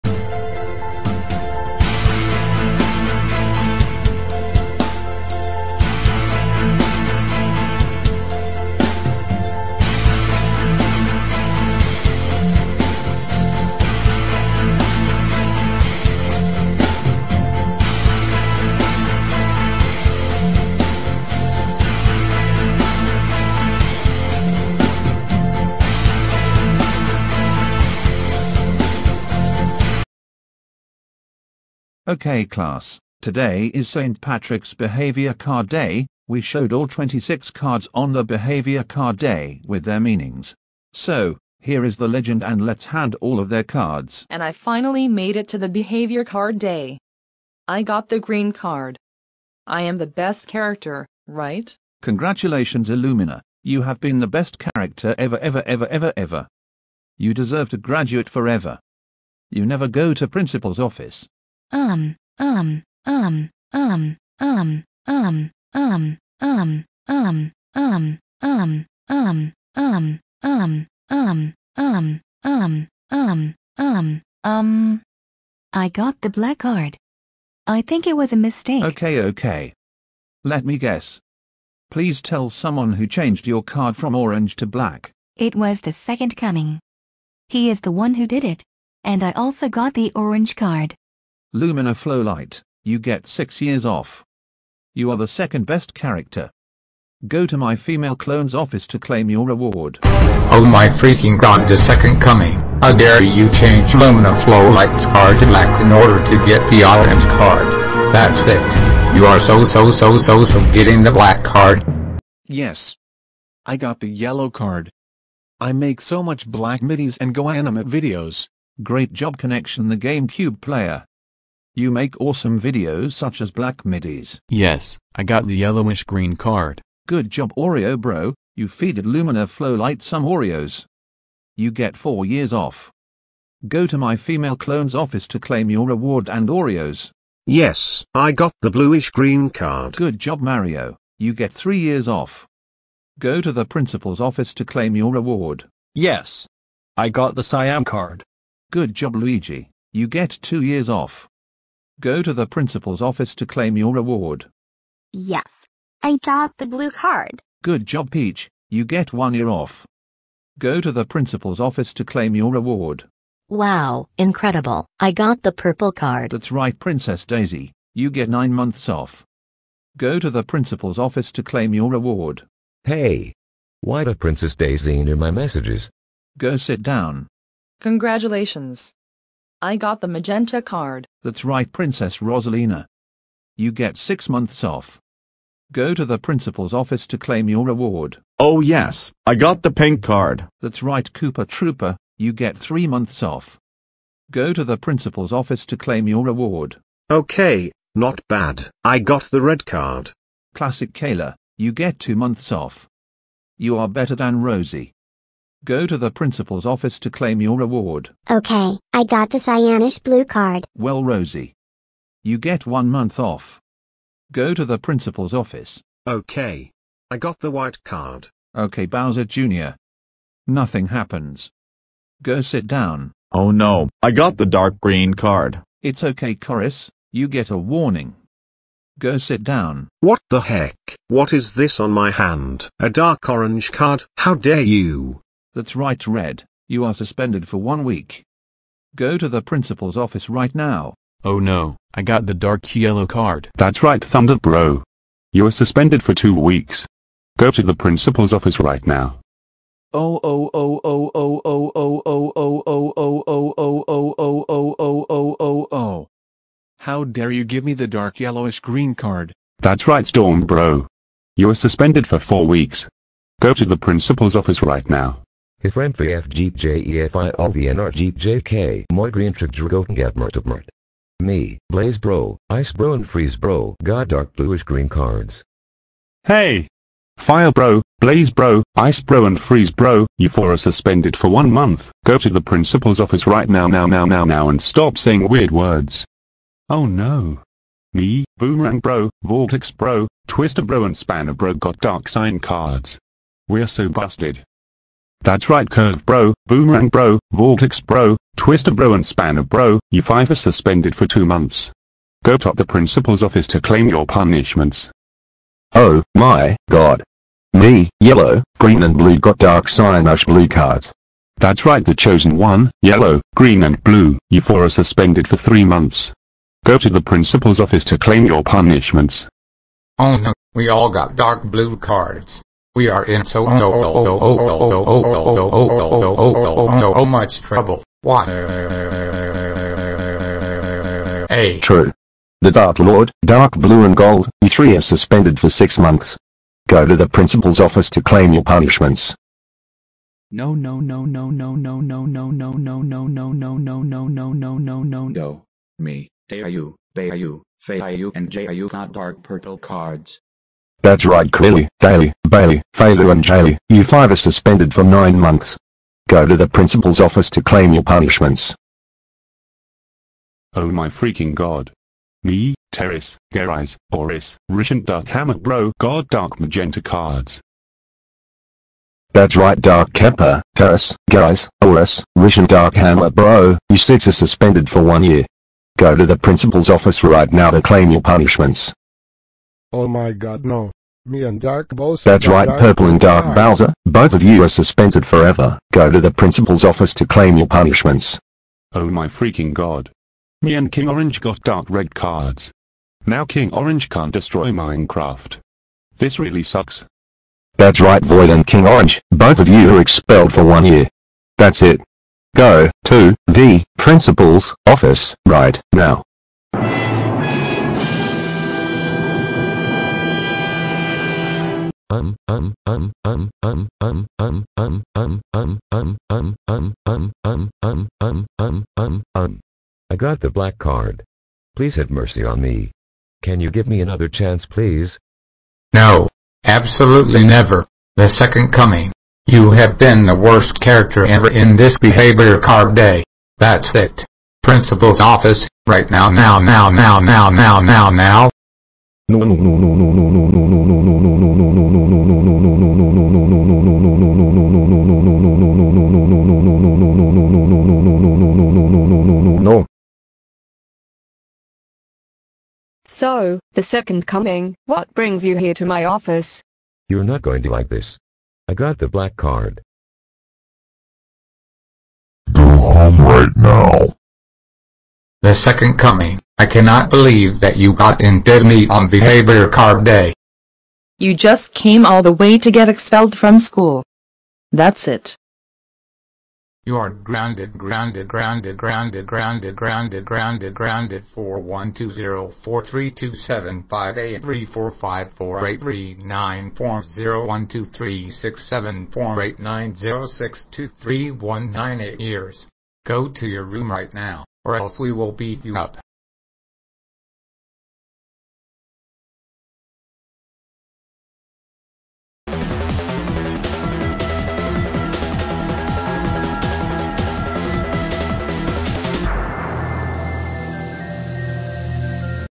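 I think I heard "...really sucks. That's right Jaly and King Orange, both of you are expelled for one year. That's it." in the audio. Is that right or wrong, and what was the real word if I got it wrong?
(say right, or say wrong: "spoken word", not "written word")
wrong: "Void", not "Jaly".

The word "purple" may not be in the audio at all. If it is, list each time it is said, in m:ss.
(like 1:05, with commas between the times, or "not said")
2:45, 5:49, 6:22.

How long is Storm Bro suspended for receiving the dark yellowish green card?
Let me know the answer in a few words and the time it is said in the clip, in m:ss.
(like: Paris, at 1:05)
4 weeks, at 4:21.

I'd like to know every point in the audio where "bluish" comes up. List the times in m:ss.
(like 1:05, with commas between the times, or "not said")
2:18, 4:34.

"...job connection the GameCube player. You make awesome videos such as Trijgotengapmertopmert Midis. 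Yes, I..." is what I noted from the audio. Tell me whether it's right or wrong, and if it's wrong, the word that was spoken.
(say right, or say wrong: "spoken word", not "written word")
wrong: "Black", not "Trijgotengapmertopmert".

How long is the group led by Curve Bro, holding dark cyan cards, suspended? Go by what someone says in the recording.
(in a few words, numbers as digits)
2 months.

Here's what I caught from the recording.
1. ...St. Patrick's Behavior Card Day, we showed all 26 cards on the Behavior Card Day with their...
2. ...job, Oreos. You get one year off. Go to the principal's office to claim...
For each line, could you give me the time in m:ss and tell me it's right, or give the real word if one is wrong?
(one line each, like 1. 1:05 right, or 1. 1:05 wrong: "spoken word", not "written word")
1. 0:33 right
2. 2:37 wrong: "Peach", not "Oreos".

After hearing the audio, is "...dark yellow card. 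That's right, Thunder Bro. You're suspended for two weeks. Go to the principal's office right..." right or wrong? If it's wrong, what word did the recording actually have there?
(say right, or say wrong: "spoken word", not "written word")
right.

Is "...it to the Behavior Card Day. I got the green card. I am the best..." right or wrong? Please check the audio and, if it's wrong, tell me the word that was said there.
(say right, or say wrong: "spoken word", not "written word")
right.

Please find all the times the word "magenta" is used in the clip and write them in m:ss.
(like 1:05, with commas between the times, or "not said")
3:00, 6:06.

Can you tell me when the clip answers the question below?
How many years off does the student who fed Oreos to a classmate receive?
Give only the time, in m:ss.
2:11.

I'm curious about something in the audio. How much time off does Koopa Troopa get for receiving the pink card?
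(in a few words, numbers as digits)
3 months.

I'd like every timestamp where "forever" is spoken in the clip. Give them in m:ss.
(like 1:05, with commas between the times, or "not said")
0:58, 6:25.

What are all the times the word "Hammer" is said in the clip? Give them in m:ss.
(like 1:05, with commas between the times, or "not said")
6:05, 6:12.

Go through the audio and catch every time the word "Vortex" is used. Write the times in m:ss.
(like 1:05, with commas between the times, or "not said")
4:49, 4:57.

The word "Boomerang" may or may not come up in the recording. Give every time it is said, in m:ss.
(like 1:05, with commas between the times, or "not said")
4:48, 4:56.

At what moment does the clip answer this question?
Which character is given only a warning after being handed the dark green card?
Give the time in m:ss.
3:45.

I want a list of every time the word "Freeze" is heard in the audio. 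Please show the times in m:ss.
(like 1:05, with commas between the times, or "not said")
4:33, 4:39.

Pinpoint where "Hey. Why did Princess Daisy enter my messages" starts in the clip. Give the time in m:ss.
2:52.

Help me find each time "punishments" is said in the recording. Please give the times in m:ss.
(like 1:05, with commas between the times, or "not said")
5:04, 5:18, 5:38, 5:57, 6:18, 6:27.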